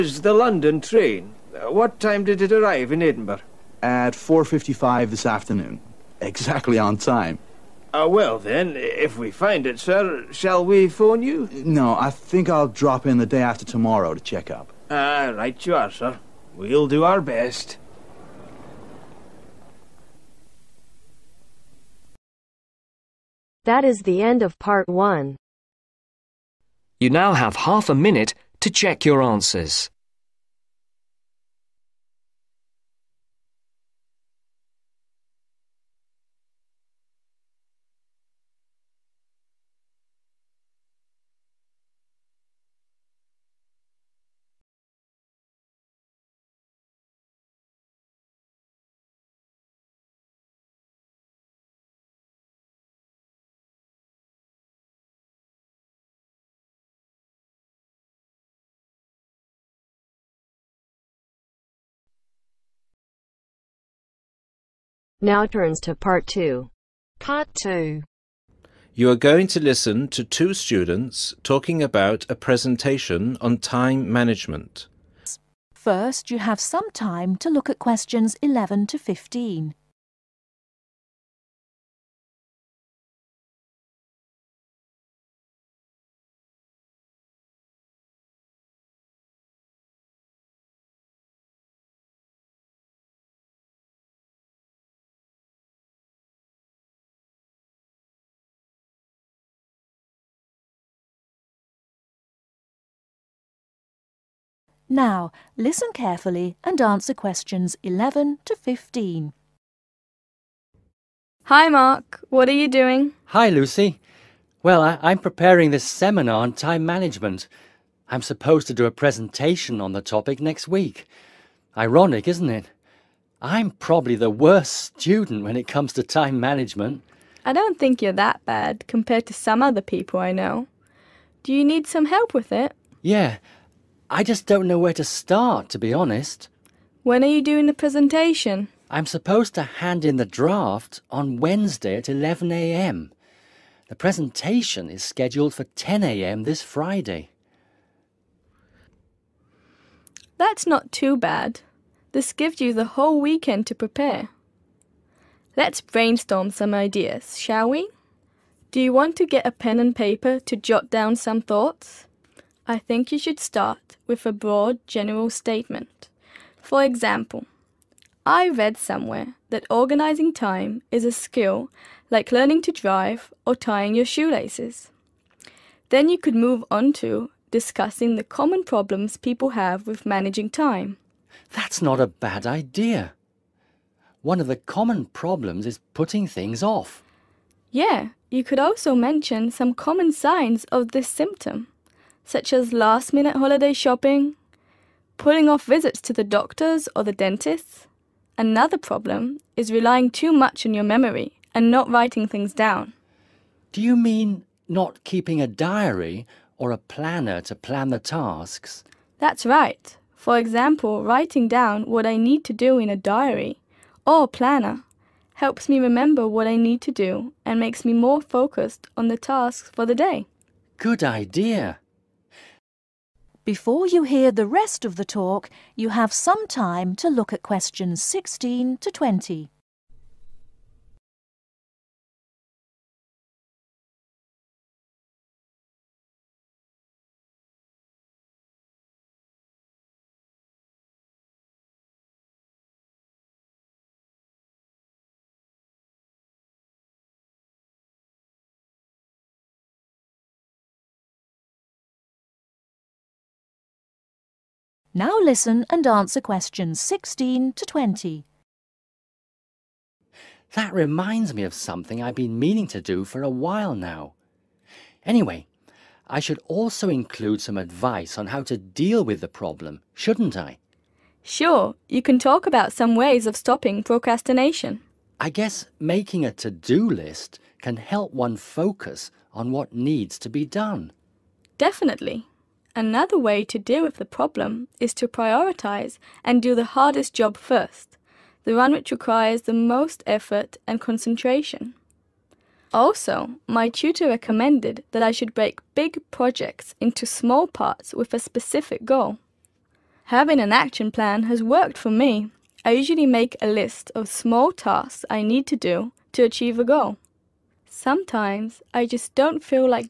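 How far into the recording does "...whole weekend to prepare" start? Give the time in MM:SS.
02:32.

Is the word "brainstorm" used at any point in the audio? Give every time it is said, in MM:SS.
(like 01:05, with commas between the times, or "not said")
02:35.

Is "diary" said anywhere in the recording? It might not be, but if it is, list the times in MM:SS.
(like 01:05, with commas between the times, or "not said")
03:25, 03:32.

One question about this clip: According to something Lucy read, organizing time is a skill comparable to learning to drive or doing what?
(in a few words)
tying your shoelaces.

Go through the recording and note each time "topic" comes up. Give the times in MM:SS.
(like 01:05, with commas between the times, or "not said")
02:00.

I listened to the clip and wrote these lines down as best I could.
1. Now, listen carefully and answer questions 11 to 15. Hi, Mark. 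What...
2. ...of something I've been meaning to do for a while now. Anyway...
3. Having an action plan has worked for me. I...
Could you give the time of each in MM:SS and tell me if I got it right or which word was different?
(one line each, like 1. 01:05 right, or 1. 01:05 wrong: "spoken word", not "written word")
1. 01:44 right
2. 04:21 right
3. 05:00 right.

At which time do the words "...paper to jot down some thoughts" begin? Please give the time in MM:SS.
02:39.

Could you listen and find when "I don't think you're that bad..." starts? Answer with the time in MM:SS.
02:07.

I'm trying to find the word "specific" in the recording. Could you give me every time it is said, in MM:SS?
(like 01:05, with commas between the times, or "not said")
04:58.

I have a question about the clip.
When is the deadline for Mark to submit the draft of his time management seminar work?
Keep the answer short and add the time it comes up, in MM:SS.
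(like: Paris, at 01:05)
Wednesday at 11am, at 02:21.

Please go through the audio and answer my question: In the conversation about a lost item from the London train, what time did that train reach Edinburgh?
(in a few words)
4:55.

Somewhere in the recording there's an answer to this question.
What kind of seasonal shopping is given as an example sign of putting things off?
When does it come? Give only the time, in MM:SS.
03:13.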